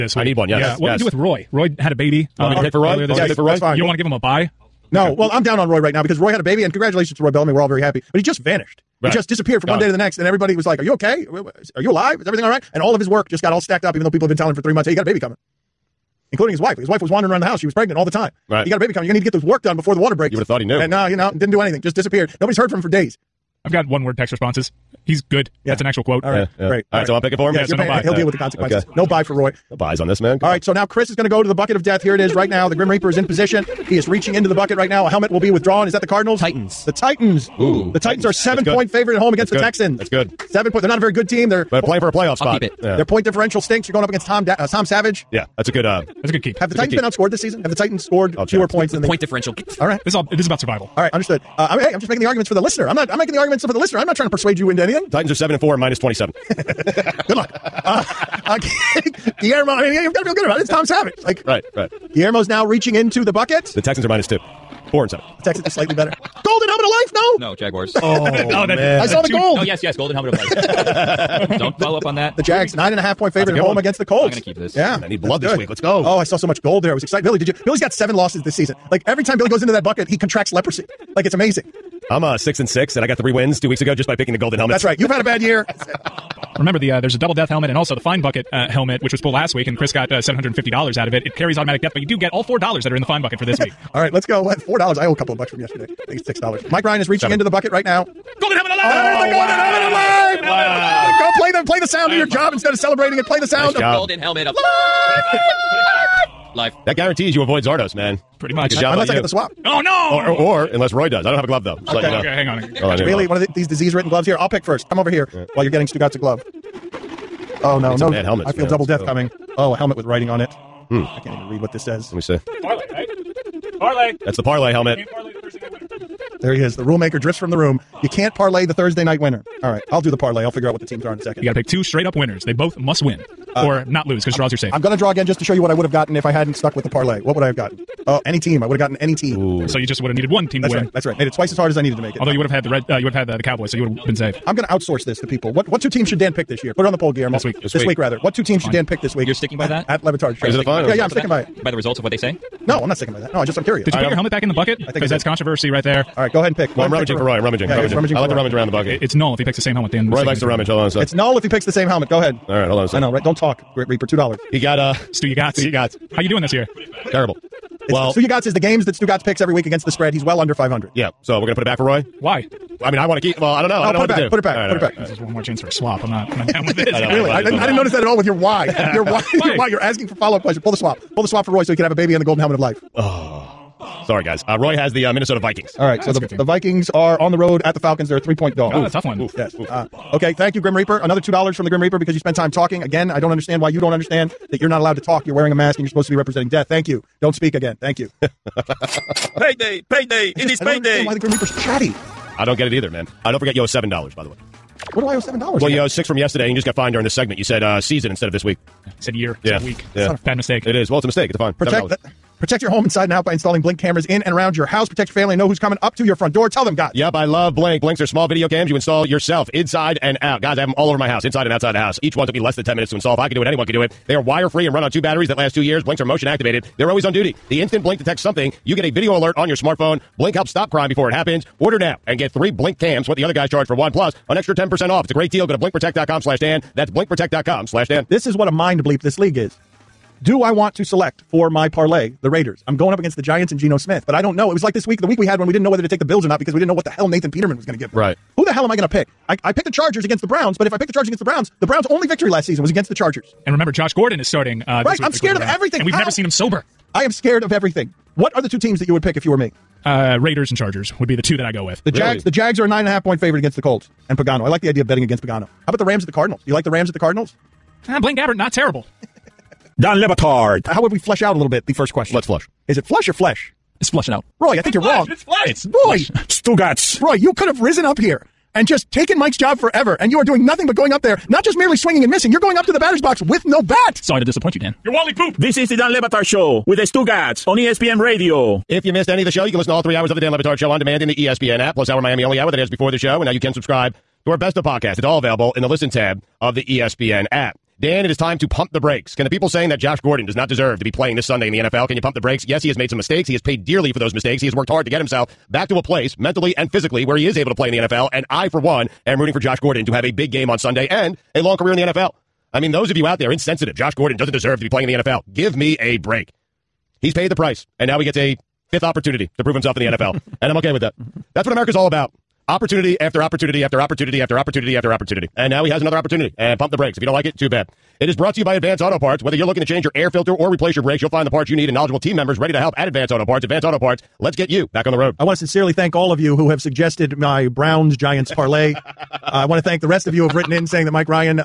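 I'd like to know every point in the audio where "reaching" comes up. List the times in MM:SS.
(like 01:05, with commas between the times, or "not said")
00:34, 01:02, 01:37.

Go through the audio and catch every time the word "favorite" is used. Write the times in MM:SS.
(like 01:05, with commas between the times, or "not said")
00:38, 01:13, 04:23.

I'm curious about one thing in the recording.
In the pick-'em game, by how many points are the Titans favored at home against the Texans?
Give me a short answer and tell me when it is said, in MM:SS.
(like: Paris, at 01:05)
7, at 00:38.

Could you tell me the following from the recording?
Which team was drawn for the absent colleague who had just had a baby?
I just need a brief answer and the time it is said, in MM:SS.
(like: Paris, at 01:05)
Minnesota Vikings, at 03:05.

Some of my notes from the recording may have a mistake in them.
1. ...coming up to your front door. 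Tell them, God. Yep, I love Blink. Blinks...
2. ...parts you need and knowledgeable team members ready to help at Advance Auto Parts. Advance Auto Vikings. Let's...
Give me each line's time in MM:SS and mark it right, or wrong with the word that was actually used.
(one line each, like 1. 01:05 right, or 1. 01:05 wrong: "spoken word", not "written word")
1. 03:35 right
2. 05:31 wrong: "Parts", not "Vikings".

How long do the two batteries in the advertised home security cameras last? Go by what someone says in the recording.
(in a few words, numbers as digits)
2 years.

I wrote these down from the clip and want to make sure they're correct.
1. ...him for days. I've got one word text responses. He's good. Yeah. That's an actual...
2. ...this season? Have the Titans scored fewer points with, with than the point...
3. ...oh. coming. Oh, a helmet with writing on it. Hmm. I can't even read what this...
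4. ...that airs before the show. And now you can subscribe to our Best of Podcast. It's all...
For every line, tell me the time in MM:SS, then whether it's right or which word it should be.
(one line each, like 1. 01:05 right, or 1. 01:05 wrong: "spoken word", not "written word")
1. 00:22 right
2. 00:47 right
3. 01:59 right
4. 04:52 right.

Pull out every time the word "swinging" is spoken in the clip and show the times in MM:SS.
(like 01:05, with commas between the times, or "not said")
04:41.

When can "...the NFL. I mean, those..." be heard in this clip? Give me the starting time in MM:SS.
05:11.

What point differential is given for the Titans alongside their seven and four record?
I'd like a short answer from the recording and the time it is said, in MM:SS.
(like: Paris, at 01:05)
-27, at 00:55.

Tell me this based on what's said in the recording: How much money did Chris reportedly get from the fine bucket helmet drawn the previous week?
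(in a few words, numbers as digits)
$750.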